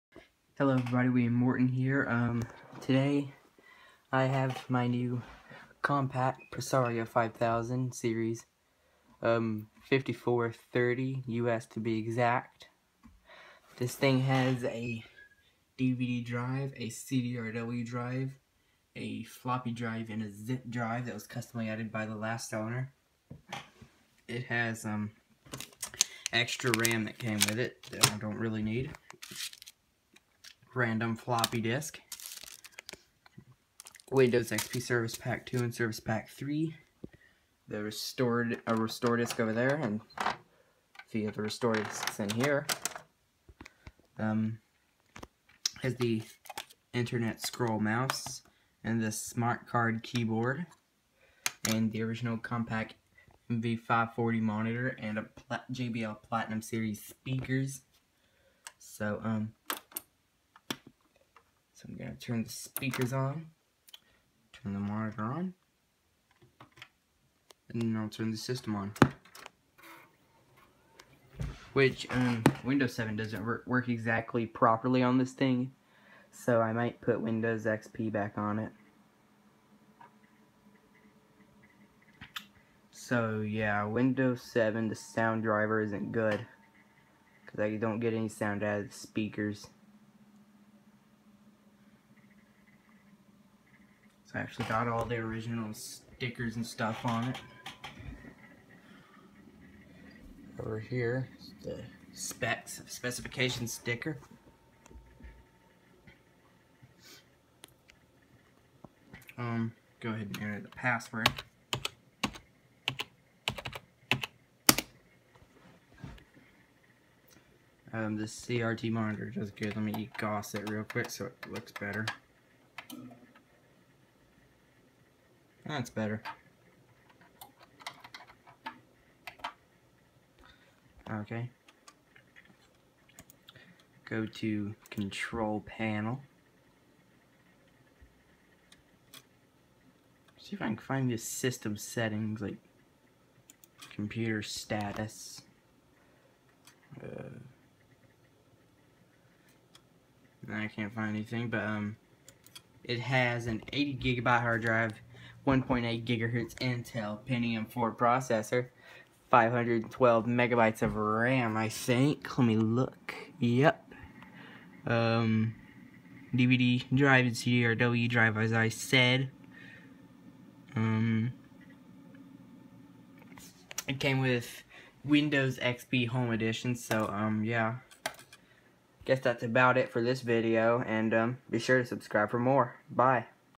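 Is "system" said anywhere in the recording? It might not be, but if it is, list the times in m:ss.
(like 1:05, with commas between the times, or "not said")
1:08, 2:21.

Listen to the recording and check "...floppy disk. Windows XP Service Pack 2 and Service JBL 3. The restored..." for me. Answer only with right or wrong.
wrong.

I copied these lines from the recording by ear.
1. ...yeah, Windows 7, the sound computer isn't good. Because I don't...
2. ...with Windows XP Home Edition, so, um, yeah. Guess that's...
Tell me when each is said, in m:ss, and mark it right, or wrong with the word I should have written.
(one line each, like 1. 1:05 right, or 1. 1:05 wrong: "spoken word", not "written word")
1. 1:23 wrong: "driver", not "computer"
2. 2:54 right.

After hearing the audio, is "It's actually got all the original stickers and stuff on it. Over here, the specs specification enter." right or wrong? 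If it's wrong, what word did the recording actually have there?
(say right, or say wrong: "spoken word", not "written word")
wrong: "sticker", not "enter".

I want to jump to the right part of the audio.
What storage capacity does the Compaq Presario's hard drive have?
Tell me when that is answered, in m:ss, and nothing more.
2:33.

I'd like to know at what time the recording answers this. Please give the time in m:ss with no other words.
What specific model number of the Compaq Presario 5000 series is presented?
0:09.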